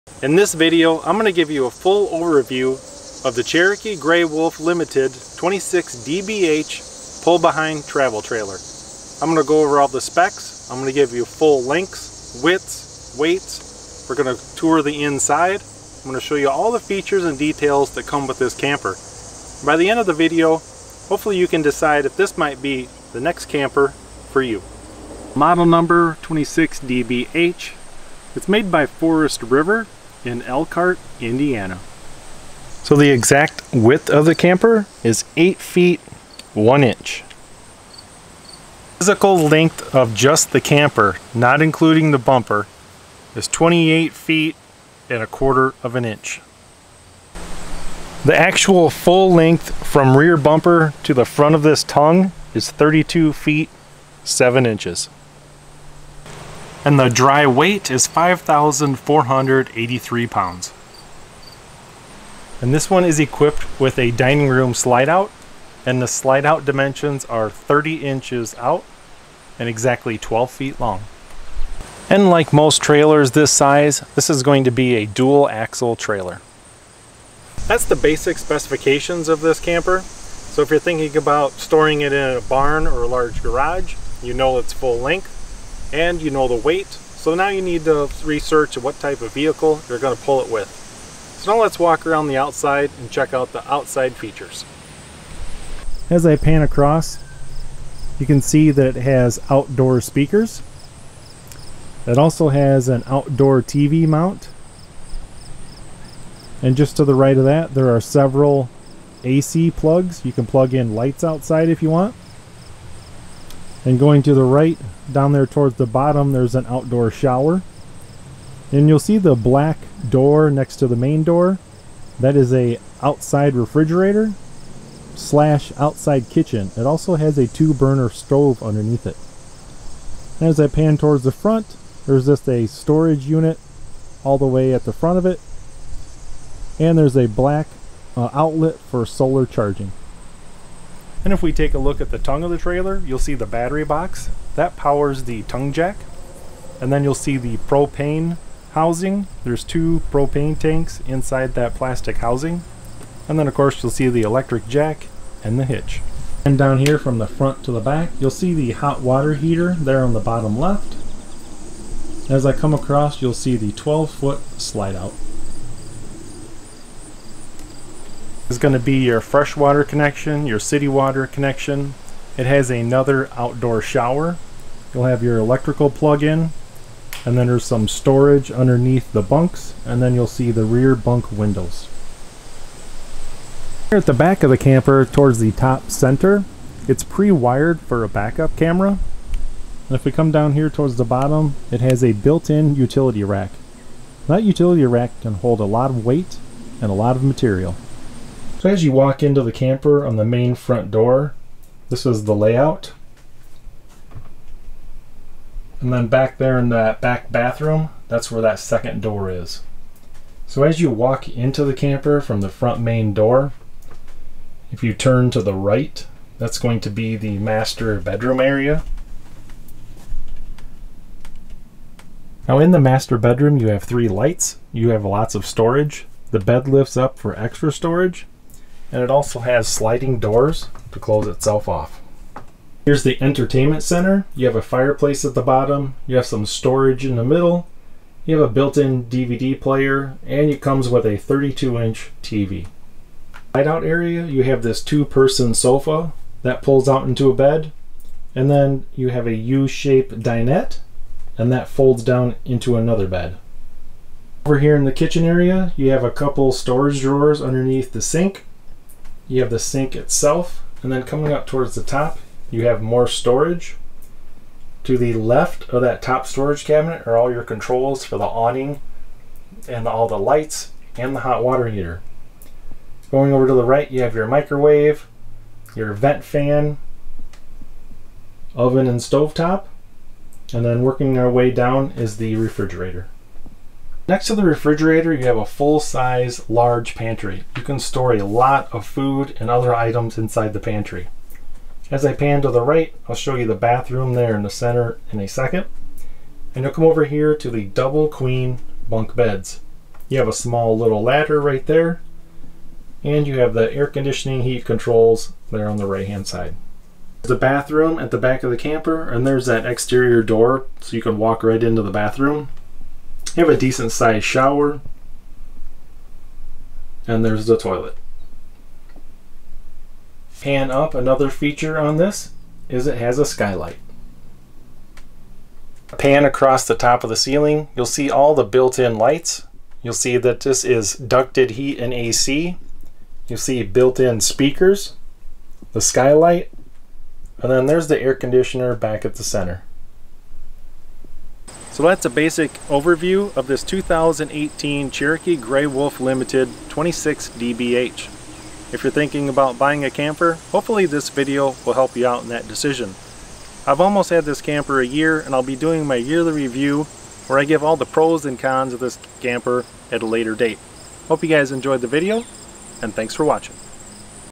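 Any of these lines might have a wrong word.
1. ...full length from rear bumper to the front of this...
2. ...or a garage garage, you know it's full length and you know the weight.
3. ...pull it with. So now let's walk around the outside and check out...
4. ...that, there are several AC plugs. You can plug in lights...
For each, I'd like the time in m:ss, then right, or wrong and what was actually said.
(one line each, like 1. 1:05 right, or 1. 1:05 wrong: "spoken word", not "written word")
1. 0:48 right
2. 1:22 wrong: "large", not "garage"
3. 1:30 right
4. 1:47 right.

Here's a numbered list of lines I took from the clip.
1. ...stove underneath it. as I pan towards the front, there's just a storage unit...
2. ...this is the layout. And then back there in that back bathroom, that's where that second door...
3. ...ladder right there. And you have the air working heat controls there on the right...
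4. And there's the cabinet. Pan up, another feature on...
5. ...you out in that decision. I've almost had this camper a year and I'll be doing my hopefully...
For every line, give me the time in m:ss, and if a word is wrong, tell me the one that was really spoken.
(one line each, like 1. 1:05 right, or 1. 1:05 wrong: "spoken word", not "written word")
1. 2:08 right
2. 3:21 right
3. 5:01 wrong: "conditioning", not "working"
4. 5:17 wrong: "toilet", not "cabinet"
5. 5:51 wrong: "yearly", not "hopefully".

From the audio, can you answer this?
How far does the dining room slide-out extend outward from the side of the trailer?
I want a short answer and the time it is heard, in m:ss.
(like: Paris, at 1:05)
30 inches, at 1:07.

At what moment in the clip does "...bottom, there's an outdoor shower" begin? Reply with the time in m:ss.
1:55.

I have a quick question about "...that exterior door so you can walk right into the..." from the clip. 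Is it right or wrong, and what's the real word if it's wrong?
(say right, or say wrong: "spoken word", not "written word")
right.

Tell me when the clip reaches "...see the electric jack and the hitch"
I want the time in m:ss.
2:33.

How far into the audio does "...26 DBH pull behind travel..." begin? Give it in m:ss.
0:05.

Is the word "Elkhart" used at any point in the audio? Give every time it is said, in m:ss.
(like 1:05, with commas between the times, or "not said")
0:30.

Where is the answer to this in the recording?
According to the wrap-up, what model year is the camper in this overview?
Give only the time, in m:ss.
5:43.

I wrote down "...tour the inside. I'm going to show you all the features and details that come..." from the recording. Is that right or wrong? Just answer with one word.
right.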